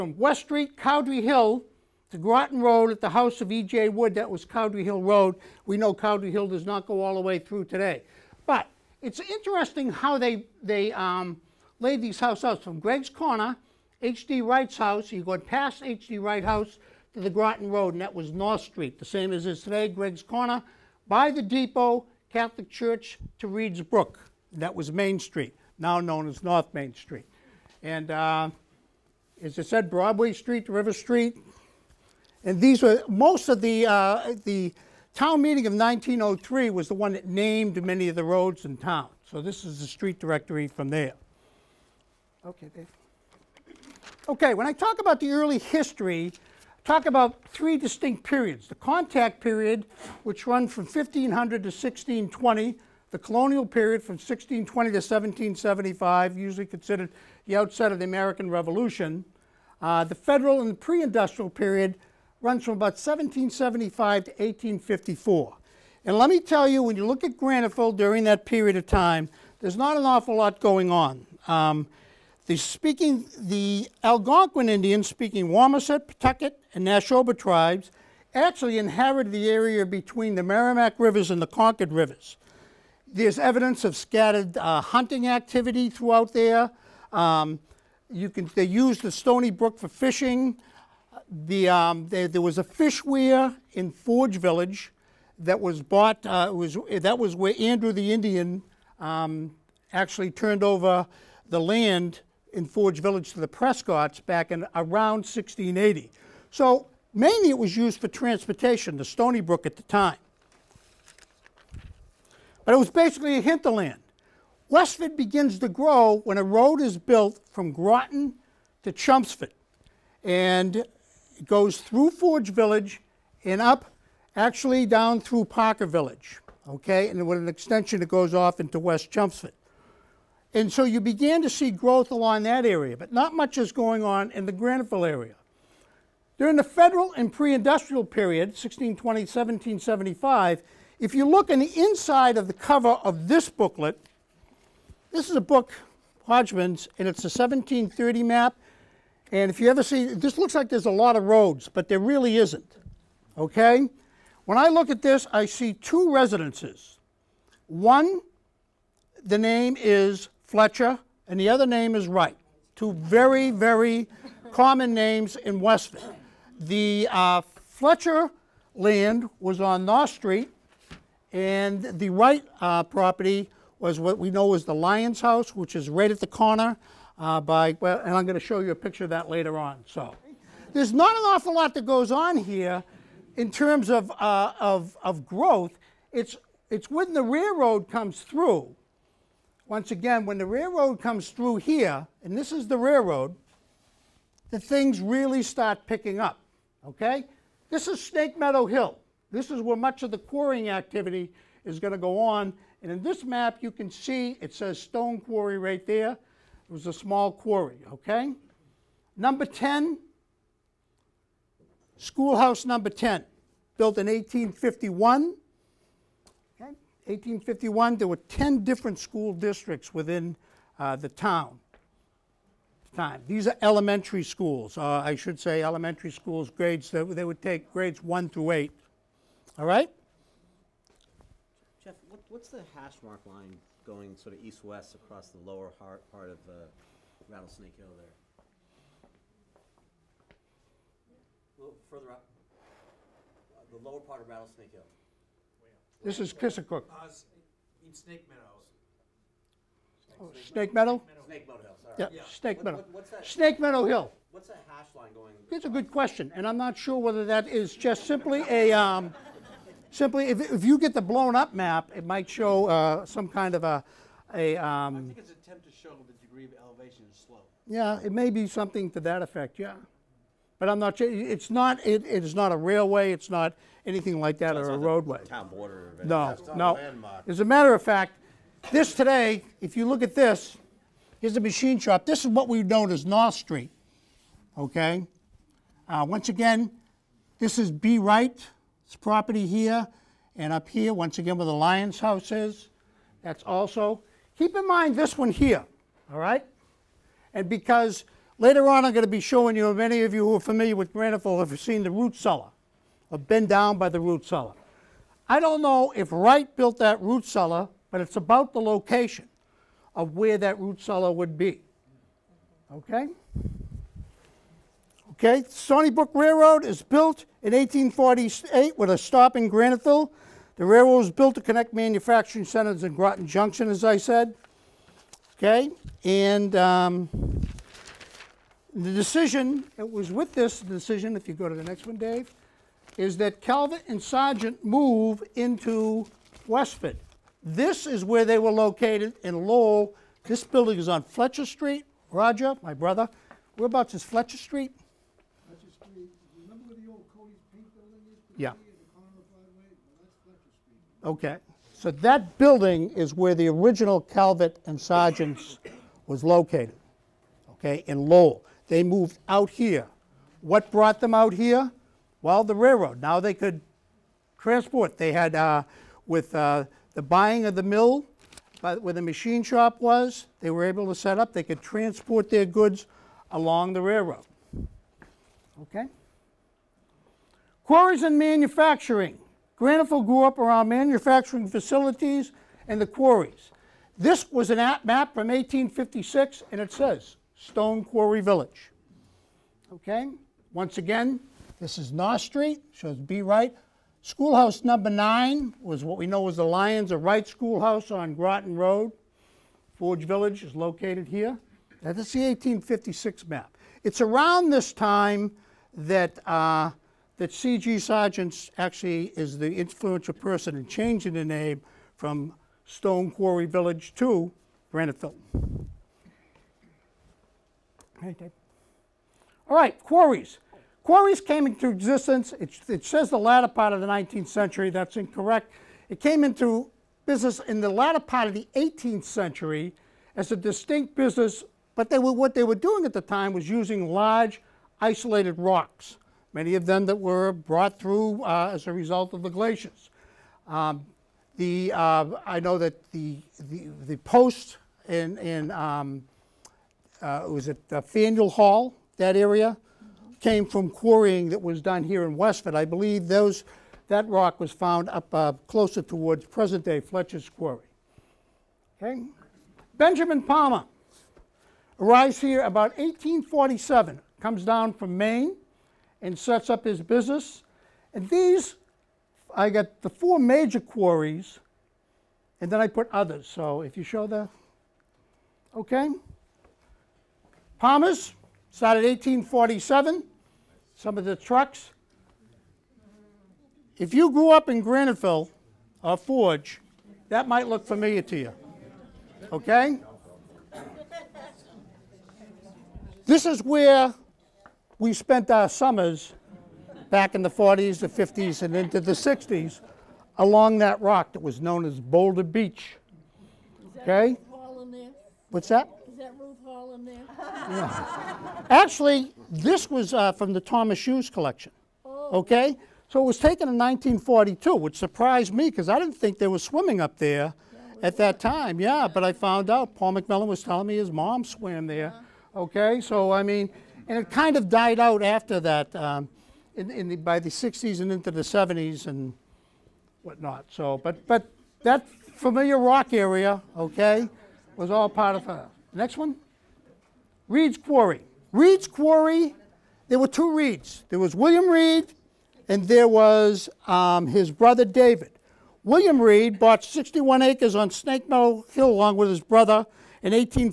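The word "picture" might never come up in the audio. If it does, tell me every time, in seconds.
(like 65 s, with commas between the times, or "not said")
178 s.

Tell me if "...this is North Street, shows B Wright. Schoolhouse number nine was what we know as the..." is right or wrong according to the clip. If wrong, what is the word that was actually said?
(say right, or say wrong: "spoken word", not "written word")
right.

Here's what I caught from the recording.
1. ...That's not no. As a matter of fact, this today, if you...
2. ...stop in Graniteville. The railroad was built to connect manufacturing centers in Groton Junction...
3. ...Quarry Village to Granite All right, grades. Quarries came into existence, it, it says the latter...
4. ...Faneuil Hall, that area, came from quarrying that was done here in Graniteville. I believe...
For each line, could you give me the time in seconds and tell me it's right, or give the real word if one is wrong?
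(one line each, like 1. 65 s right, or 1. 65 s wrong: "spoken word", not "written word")
1. 276 s right
2. 318 s right
3. 413 s wrong: "quarries", not "grades"
4. 447 s wrong: "Westford", not "Graniteville".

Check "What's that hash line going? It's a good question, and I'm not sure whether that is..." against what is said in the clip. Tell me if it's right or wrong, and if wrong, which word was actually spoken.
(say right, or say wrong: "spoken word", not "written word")
right.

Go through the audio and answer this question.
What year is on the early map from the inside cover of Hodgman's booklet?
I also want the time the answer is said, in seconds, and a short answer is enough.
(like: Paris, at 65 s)
1730, at 147 s.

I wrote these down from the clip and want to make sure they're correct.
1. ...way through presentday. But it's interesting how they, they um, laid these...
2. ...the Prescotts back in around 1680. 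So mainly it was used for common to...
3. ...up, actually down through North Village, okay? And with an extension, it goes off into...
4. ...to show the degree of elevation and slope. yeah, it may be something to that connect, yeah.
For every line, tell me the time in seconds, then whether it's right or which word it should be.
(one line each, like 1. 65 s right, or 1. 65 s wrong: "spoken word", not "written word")
1. 7 s wrong: "today", not "presentday"
2. 103 s wrong: "transportation", not "common"
3. 123 s wrong: "Parker", not "North"
4. 265 s wrong: "effect", not "connect".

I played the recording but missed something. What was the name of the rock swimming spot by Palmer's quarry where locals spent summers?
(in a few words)
Boulder Beach.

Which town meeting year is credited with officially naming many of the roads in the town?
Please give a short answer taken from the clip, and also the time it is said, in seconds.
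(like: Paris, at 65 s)
1903, at 35 s.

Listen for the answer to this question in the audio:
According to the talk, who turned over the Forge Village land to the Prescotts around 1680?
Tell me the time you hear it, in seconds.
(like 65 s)
97 s.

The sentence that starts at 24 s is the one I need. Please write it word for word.
That was Main Street, now known as North Main Street.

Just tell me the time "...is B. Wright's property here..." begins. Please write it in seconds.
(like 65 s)
287 s.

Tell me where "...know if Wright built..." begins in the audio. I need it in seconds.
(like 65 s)
305 s.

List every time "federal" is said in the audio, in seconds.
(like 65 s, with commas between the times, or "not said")
60 s, 136 s.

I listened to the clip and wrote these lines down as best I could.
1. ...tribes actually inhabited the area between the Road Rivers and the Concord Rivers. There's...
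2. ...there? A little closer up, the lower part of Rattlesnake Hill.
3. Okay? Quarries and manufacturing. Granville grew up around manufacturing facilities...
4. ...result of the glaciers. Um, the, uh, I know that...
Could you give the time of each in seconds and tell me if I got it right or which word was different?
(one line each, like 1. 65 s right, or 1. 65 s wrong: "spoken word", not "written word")
1. 77 s wrong: "Merrimack", not "Road"
2. 237 s wrong: "further", not "closer"
3. 375 s right
4. 438 s right.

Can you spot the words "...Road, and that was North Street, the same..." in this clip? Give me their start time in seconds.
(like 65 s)
17 s.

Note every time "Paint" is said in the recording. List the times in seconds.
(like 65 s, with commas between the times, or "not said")
347 s.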